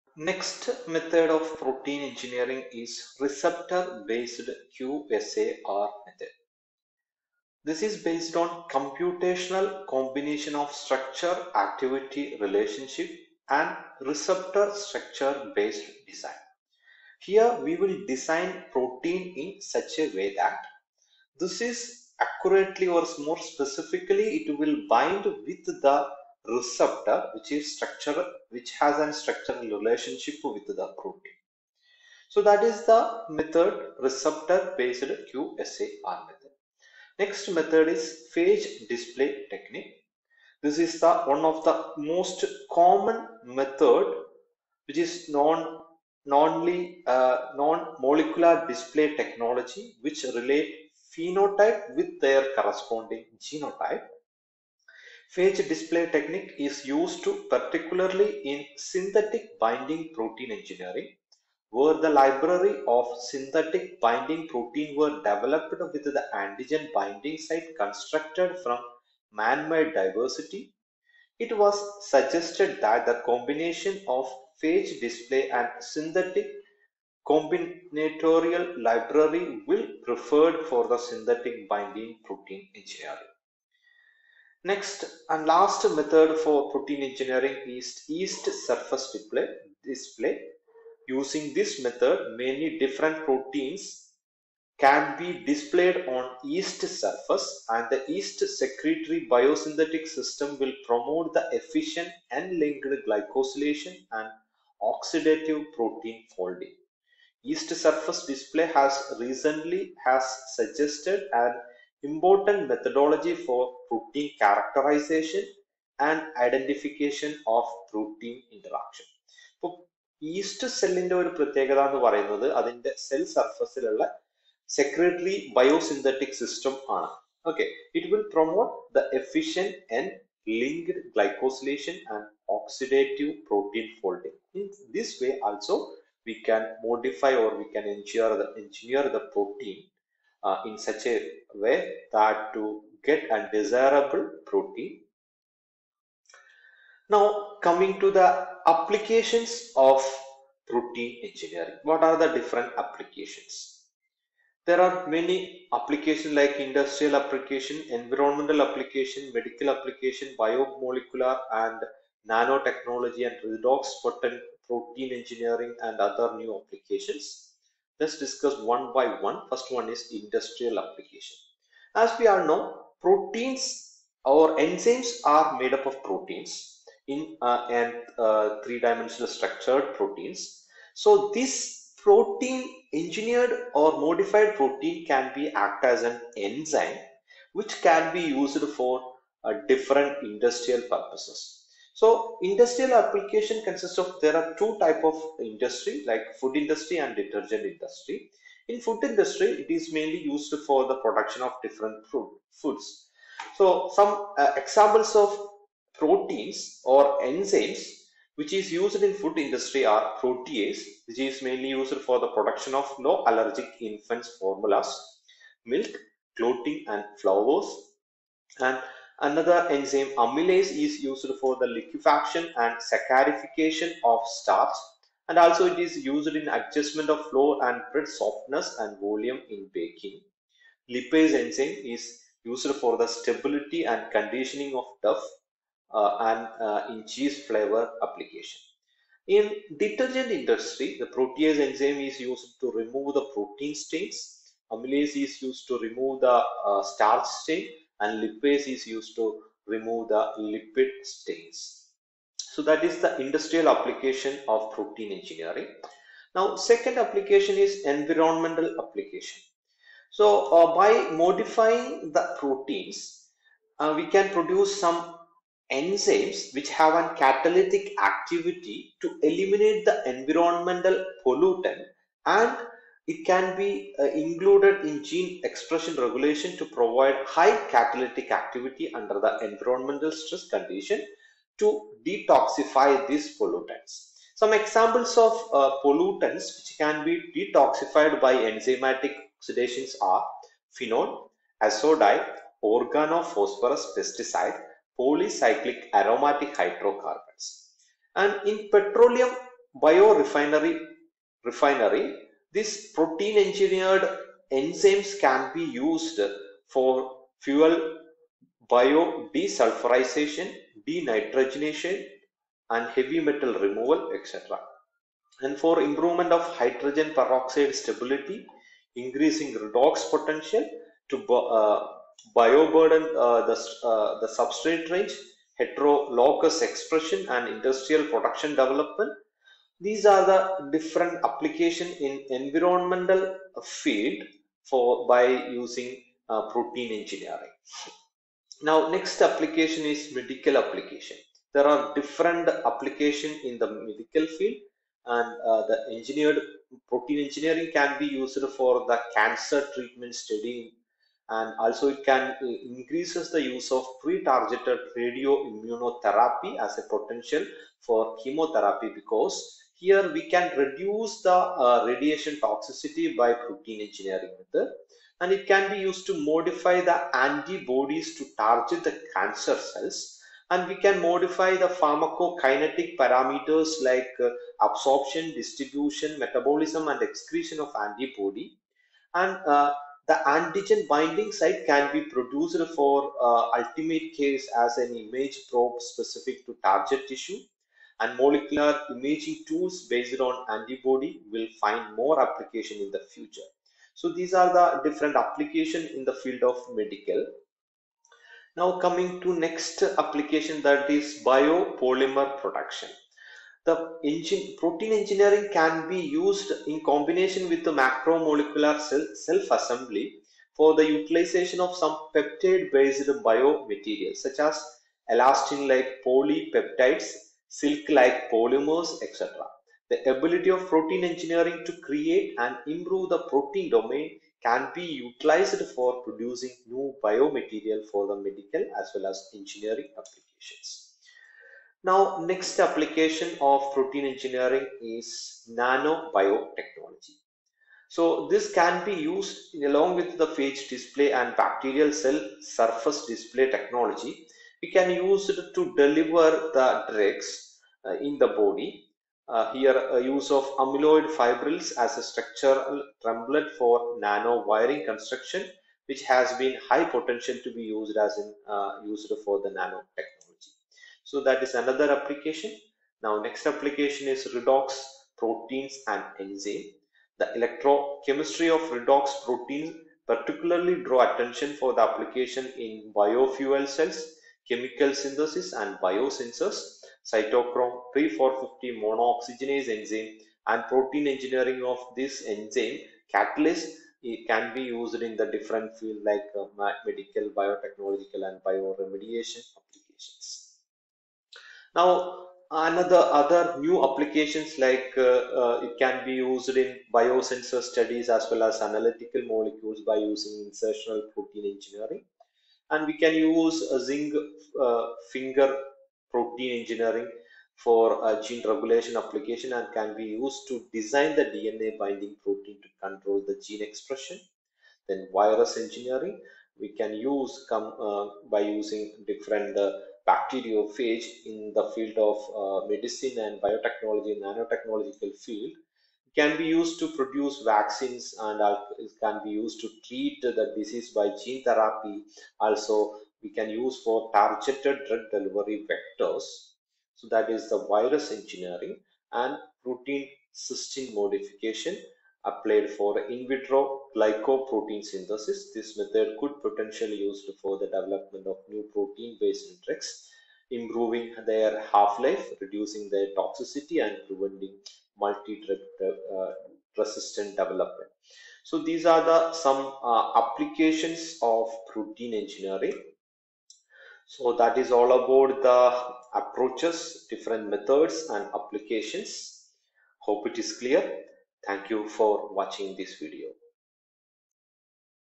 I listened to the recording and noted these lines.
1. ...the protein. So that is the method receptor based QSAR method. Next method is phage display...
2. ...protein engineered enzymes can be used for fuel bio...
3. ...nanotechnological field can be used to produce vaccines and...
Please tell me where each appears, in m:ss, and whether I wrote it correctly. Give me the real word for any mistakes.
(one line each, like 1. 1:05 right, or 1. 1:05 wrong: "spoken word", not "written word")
1. 0:30 right
2. 5:02 right
3. 8:44 right.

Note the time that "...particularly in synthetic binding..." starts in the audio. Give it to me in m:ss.
0:57.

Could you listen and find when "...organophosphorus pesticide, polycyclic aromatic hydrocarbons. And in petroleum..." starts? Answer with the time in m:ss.
4:52.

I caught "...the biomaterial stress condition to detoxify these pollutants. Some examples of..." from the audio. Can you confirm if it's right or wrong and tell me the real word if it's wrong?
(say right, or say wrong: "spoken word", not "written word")
wrong: "environmental", not "biomaterial".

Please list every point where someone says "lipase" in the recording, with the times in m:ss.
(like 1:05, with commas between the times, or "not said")
3:50, 4:08.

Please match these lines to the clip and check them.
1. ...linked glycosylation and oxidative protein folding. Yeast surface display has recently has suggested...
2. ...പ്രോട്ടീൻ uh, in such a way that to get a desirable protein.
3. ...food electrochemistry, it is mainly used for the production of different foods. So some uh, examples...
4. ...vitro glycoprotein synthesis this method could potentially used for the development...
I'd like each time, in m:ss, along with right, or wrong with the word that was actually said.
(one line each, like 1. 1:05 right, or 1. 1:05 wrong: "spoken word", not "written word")
1. 1:42 right
2. 2:19 right
3. 3:18 wrong: "industry", not "electrochemistry"
4. 9:03 right.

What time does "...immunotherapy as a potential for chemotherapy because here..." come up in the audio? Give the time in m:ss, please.
5:55.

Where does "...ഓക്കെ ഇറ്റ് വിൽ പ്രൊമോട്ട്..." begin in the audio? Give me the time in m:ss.
2:07.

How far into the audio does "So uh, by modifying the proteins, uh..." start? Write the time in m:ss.
4:20.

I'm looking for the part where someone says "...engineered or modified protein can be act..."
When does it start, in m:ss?
3:02.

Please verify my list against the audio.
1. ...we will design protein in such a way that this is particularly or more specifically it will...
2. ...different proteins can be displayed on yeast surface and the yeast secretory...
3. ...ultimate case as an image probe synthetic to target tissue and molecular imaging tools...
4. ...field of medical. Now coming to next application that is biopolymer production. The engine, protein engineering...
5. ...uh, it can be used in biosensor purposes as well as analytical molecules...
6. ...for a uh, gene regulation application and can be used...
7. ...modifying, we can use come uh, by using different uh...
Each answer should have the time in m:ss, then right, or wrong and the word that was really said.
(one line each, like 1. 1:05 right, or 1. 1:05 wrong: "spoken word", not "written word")
1. 0:17 wrong: "accurately", not "particularly"
2. 1:32 right
3. 6:23 wrong: "specific", not "synthetic"
4. 6:36 right
5. 8:15 wrong: "studies", not "purposes"
6. 8:27 right
7. 8:35 wrong: "engineering", not "modifying".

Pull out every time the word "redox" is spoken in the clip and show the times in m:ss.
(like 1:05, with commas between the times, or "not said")
2:43, 5:19, 7:44, 7:48.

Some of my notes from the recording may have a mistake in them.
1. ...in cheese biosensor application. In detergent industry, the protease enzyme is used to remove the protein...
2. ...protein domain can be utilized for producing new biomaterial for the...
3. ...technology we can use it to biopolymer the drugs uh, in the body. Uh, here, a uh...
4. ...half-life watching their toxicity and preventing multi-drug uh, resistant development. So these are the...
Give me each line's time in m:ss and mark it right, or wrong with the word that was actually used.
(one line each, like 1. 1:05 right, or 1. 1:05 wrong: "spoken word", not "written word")
1. 3:56 wrong: "flavor", not "biosensor"
2. 7:03 right
3. 7:23 wrong: "deliver", not "biopolymer"
4. 9:11 wrong: "reducing", not "watching".